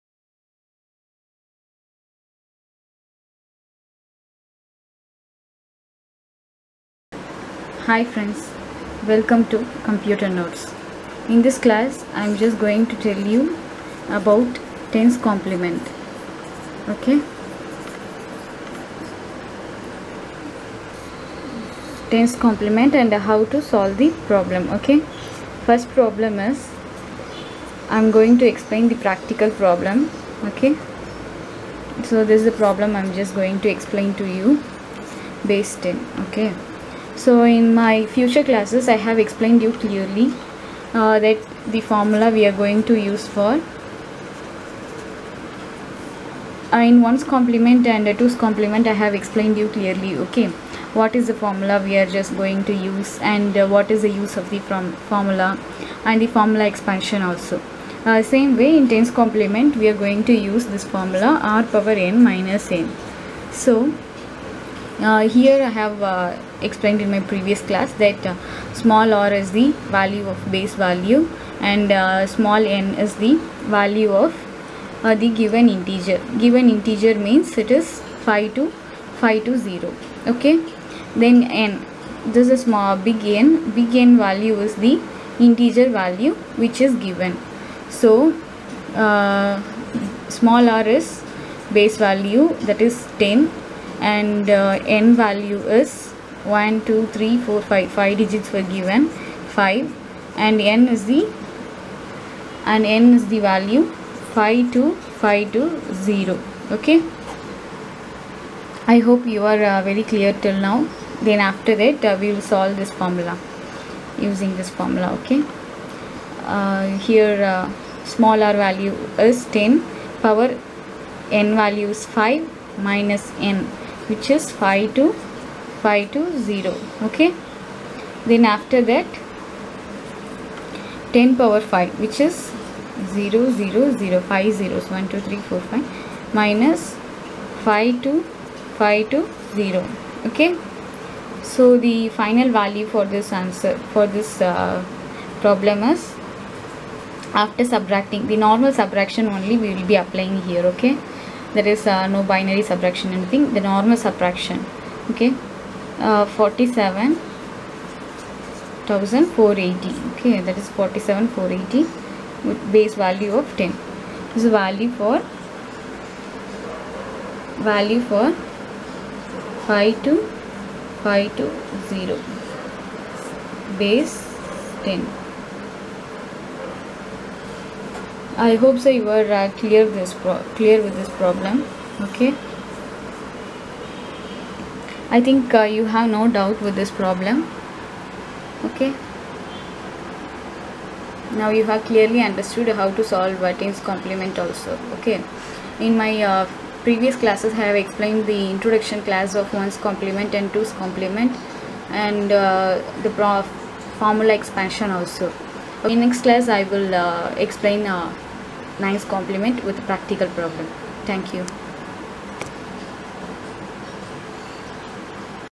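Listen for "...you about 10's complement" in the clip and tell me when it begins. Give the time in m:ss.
0:13.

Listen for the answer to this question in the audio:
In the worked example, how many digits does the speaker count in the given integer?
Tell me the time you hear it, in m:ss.
1:38.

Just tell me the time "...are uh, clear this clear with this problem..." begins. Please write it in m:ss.
2:59.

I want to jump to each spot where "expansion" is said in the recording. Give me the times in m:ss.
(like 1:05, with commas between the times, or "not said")
0:56, 3:24.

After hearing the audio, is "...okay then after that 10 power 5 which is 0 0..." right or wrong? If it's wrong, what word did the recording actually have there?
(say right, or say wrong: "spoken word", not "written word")
right.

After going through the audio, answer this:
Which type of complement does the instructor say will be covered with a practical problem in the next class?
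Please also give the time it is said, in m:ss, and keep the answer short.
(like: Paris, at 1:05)
9's complement, at 3:28.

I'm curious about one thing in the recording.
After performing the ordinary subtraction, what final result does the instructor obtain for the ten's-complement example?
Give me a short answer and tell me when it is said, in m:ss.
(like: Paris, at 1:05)
47480, at 2:40.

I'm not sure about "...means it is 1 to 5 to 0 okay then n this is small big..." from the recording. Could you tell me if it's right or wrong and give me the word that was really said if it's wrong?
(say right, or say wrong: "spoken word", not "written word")
wrong: "5", not "1".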